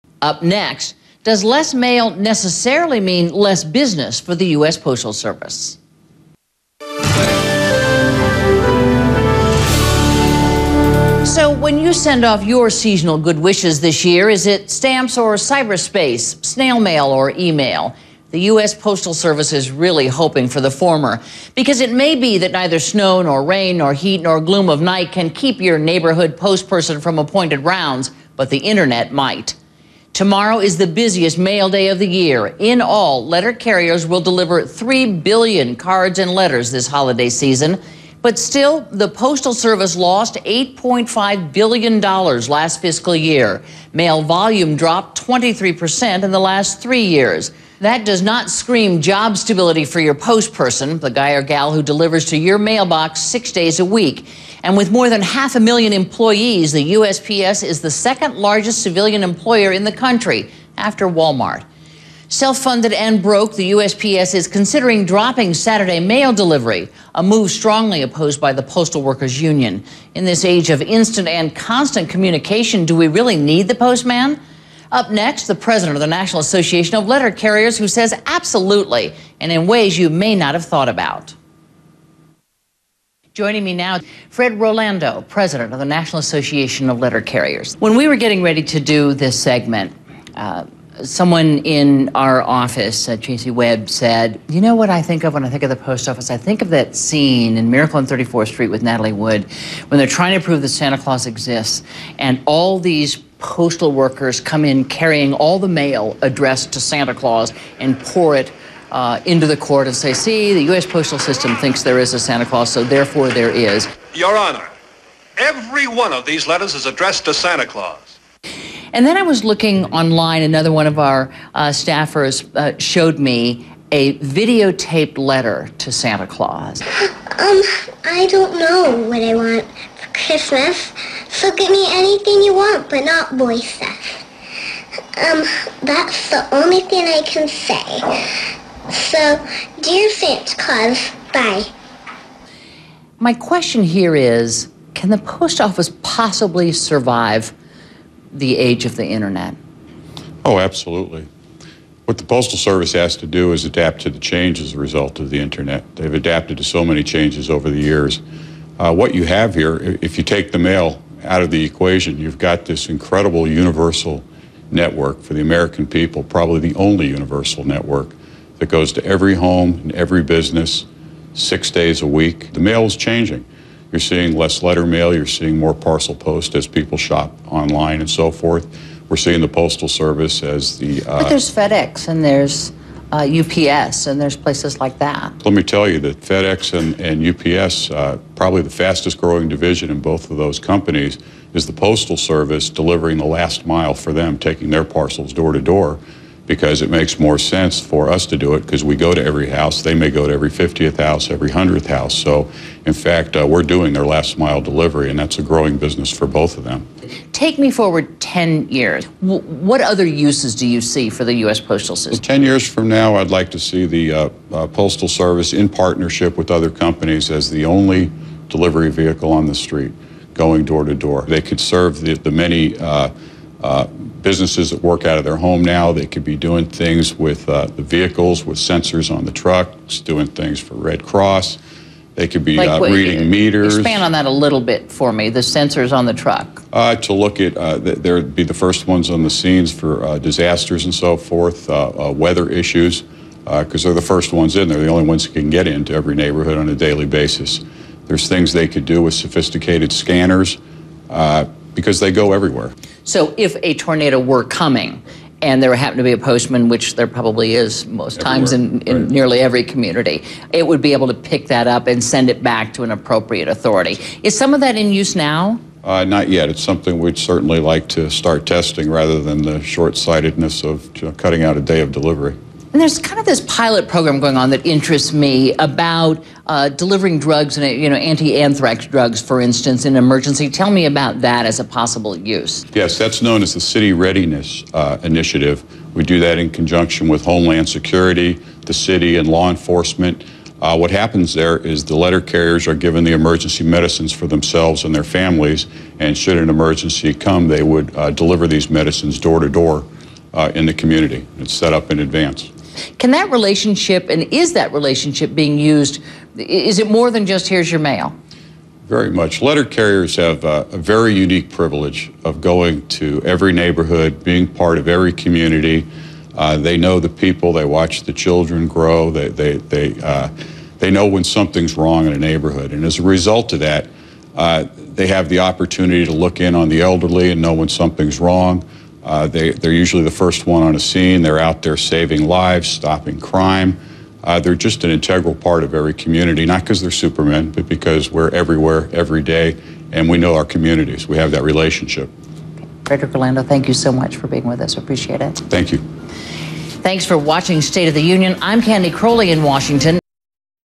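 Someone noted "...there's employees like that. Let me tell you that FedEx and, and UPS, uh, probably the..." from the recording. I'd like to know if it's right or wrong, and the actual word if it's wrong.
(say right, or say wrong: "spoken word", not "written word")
wrong: "places", not "employees".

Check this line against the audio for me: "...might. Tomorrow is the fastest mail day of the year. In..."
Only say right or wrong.
wrong.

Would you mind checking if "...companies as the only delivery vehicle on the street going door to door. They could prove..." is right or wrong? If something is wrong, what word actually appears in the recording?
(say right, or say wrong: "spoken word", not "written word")
wrong: "serve", not "prove".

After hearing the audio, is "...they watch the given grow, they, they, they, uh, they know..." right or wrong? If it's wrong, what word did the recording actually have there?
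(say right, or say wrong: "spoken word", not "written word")
wrong: "children", not "given".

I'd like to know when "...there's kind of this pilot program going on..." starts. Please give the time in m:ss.
4:32.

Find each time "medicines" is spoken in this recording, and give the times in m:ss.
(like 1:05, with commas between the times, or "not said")
4:53, 4:58.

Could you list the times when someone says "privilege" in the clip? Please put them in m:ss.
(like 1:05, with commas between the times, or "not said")
5:11.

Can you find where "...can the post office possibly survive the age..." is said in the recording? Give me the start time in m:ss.
2:24.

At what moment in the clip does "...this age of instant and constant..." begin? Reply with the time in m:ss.
1:10.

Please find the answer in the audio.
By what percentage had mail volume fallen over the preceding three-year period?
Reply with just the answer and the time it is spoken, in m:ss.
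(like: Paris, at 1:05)
23%, at 0:45.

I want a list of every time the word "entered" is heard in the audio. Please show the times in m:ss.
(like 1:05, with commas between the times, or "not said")
not said.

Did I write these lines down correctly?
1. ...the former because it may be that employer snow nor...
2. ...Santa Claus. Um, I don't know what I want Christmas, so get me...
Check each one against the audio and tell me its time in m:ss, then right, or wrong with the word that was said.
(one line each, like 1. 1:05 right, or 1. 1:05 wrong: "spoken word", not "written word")
1. 0:20 wrong: "neither", not "employer"
2. 2:05 right.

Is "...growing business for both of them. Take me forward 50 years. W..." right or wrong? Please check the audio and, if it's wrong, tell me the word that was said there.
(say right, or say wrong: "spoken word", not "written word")
wrong: "10", not "50".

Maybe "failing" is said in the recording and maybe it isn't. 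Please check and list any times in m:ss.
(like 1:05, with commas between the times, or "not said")
not said.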